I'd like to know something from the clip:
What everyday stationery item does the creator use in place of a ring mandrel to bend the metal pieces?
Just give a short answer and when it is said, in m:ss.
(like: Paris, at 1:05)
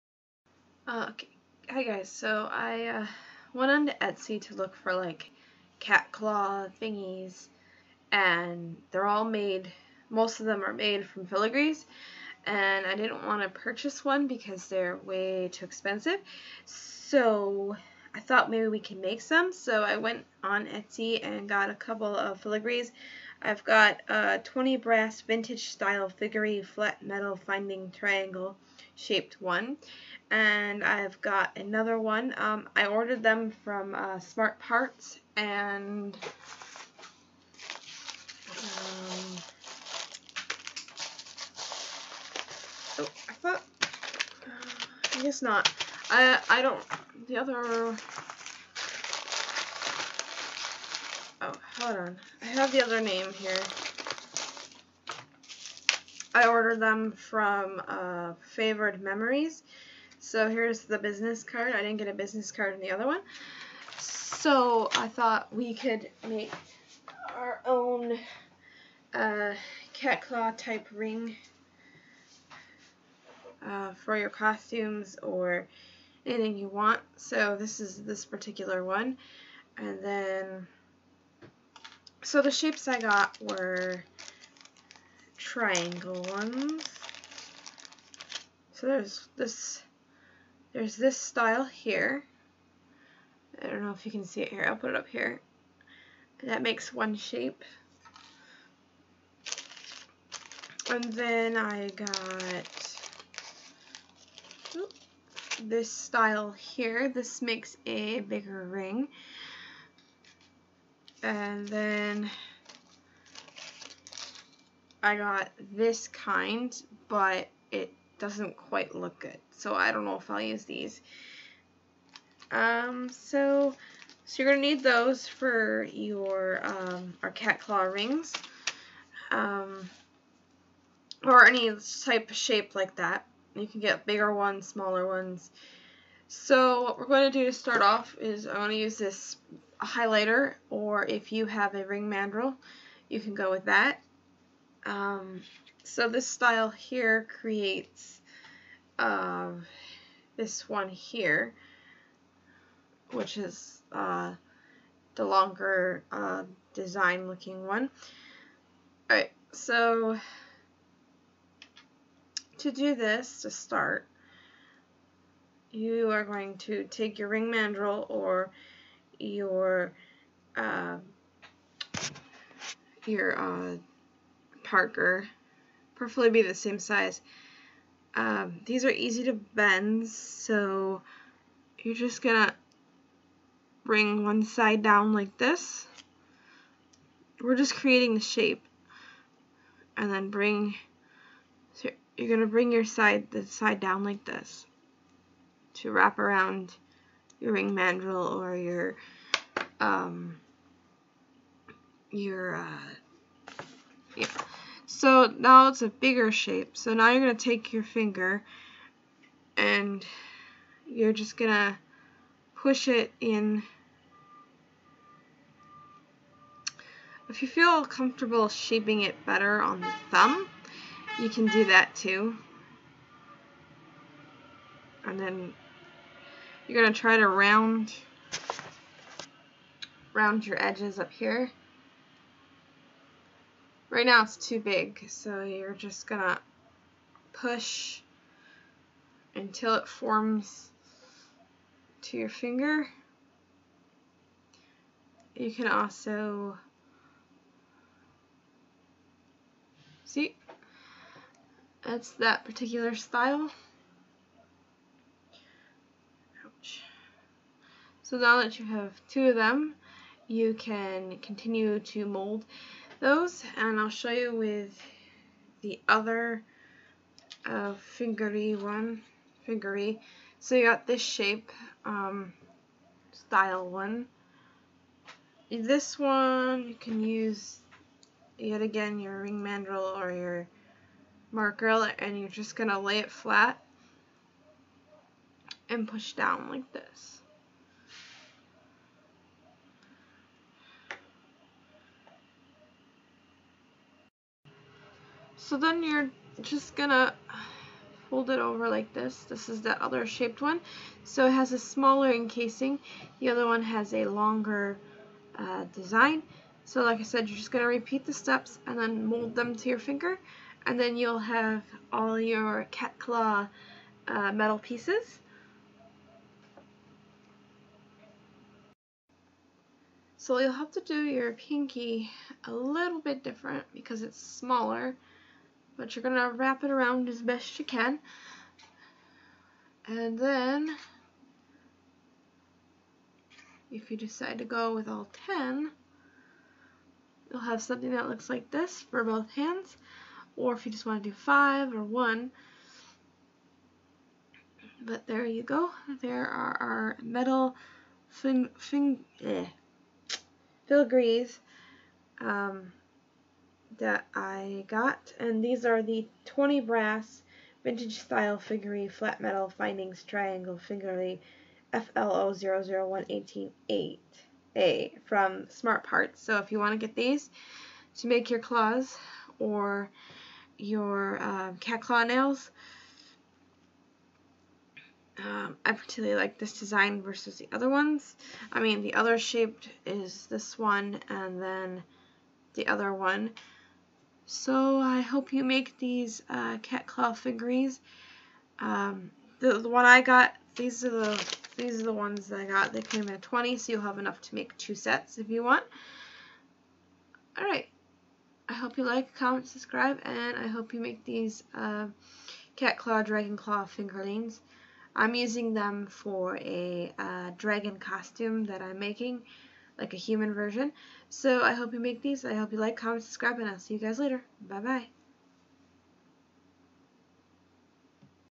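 Highlighter, at 2:19.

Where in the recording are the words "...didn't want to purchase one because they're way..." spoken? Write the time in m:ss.
0:12.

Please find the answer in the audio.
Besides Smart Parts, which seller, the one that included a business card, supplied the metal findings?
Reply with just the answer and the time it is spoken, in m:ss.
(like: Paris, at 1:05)
Favored Memories, at 0:58.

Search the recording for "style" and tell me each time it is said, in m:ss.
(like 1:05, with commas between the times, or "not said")
0:25, 1:31, 1:45, 2:26, 4:12, 4:33, 5:57.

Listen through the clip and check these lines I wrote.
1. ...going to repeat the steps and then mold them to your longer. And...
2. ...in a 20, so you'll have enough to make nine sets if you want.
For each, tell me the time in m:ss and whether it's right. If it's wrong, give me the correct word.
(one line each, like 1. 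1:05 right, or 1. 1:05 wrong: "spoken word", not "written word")
1. 5:07 wrong: "finger", not "longer"
2. 6:33 wrong: "two", not "nine".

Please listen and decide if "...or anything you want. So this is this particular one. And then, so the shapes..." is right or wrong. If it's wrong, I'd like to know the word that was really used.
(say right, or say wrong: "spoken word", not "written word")
right.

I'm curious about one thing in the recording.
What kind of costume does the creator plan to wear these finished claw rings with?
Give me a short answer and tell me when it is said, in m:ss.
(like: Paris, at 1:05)
Dragon costume, at 6:47.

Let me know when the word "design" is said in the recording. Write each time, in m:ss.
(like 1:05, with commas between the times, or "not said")
2:36, 5:05, 6:16.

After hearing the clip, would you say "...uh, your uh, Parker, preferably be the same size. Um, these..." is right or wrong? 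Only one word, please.
right.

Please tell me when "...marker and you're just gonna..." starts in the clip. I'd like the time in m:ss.
4:41.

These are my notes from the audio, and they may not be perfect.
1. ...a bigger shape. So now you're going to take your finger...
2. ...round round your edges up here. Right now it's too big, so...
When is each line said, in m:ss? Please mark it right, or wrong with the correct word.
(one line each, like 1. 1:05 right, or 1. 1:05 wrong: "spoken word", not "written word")
1. 3:25 right
2. 3:47 right.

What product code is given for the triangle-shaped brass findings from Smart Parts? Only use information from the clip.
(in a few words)
FLO001188A.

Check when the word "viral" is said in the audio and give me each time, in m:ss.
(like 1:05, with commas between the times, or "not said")
not said.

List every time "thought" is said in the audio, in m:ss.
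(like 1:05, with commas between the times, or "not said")
0:18, 0:43, 1:05.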